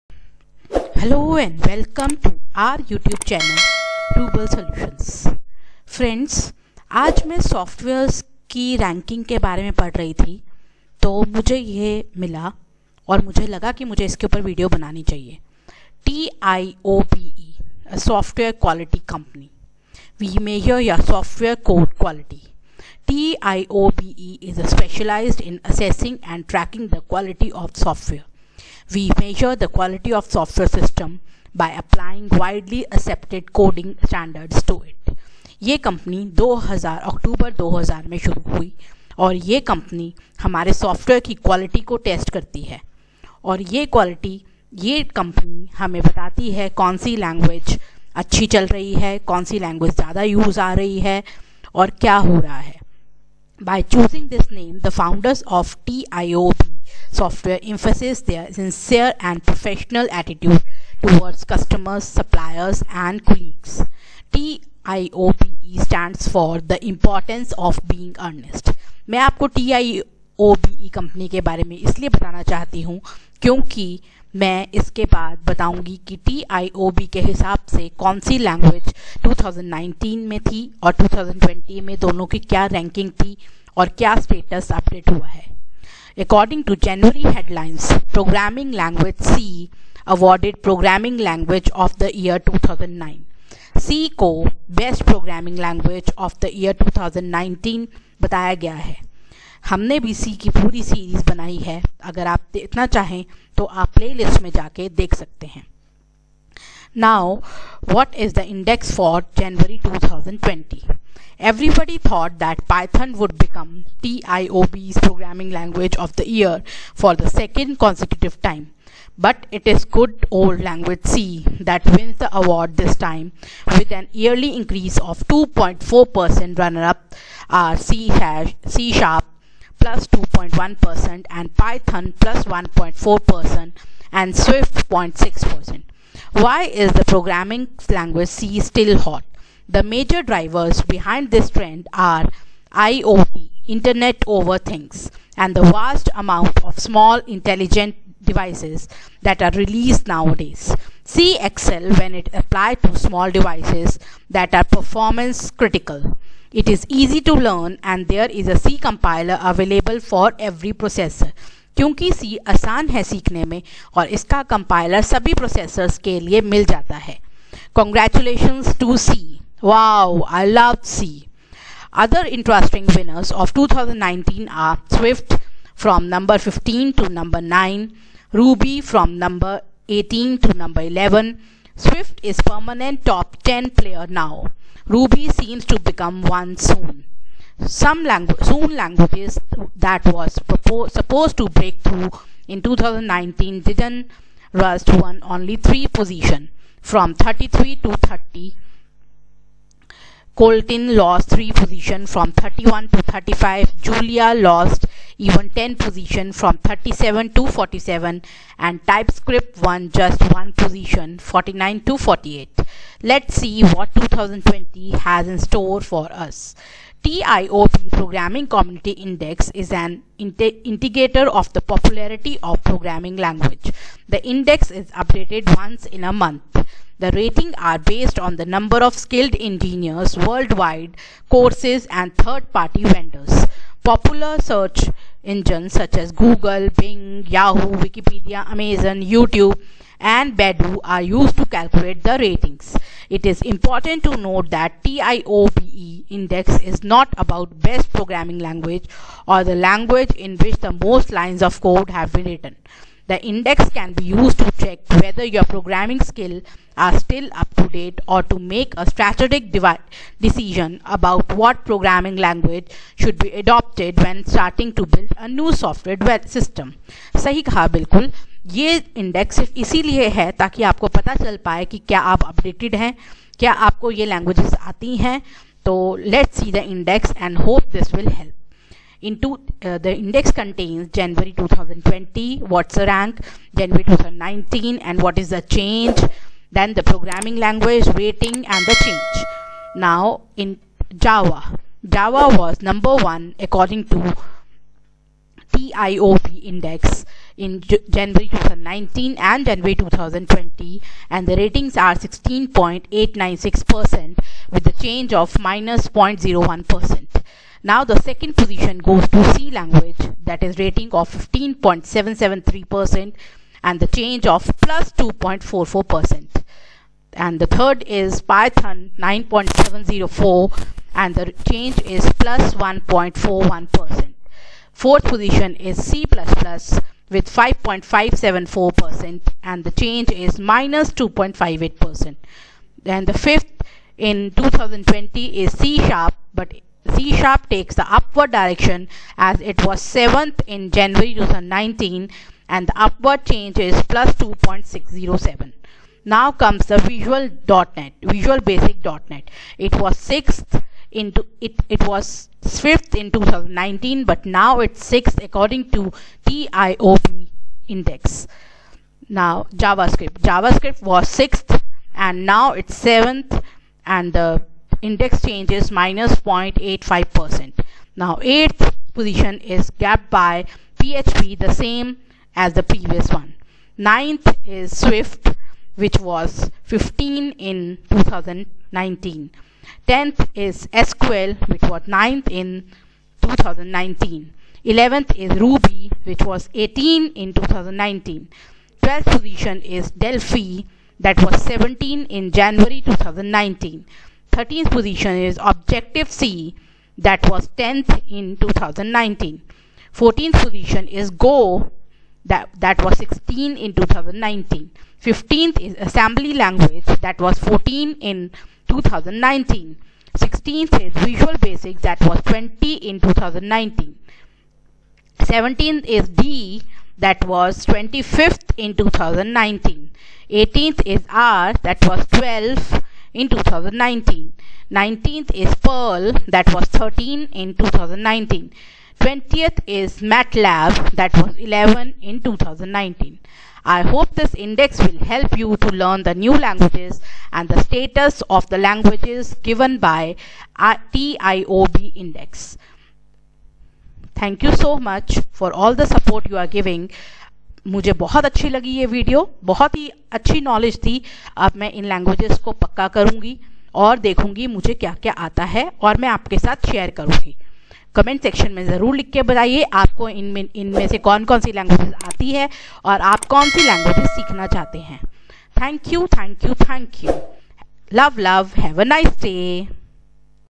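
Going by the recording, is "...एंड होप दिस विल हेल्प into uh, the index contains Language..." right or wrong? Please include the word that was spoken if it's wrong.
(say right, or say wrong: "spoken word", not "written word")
wrong: "January", not "Language".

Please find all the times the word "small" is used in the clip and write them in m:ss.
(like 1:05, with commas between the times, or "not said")
2:26, 2:32.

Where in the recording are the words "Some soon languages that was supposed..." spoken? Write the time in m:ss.
3:07.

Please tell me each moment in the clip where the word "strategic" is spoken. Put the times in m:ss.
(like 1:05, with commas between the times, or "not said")
4:18.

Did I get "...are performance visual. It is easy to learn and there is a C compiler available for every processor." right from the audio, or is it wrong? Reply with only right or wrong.
wrong.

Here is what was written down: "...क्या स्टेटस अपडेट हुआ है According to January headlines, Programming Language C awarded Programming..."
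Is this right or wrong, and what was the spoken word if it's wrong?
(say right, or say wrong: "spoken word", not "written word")
right.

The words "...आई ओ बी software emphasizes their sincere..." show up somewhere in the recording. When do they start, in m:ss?
0:56.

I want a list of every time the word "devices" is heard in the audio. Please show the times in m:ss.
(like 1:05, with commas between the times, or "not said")
2:28, 2:33.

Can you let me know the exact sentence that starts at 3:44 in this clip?
The index is updated once in a month.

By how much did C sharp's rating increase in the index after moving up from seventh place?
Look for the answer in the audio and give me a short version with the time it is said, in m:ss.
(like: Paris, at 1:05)
2.607, at 5:43.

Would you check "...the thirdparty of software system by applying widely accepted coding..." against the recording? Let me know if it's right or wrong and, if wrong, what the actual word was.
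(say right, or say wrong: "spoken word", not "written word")
wrong: "quality", not "thirdparty".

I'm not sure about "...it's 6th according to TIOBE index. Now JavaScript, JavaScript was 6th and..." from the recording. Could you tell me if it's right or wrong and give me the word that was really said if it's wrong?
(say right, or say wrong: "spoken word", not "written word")
right.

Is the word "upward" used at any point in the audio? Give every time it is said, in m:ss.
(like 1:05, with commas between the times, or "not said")
5:37, 5:42.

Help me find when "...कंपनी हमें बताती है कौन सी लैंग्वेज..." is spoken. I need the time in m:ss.
0:45.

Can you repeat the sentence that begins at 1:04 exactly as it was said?
TIOBE stands for the importance of being earnest.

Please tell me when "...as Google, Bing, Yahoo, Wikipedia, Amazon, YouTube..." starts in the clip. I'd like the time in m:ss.
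3:55.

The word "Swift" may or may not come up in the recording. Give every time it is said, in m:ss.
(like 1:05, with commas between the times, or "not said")
2:14, 2:54, 3:01, 6:14.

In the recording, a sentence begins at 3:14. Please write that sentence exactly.
Rust won only three position from 33 to 30 Kotlin lost 3 positions from 31 to 35.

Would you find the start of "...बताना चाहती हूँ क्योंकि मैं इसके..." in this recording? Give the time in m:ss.
1:12.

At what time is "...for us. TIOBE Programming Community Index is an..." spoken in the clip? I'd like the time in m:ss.
3:35.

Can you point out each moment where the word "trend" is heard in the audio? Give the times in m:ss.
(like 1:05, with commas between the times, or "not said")
2:21.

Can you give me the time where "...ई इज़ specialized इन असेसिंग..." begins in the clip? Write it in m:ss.
0:24.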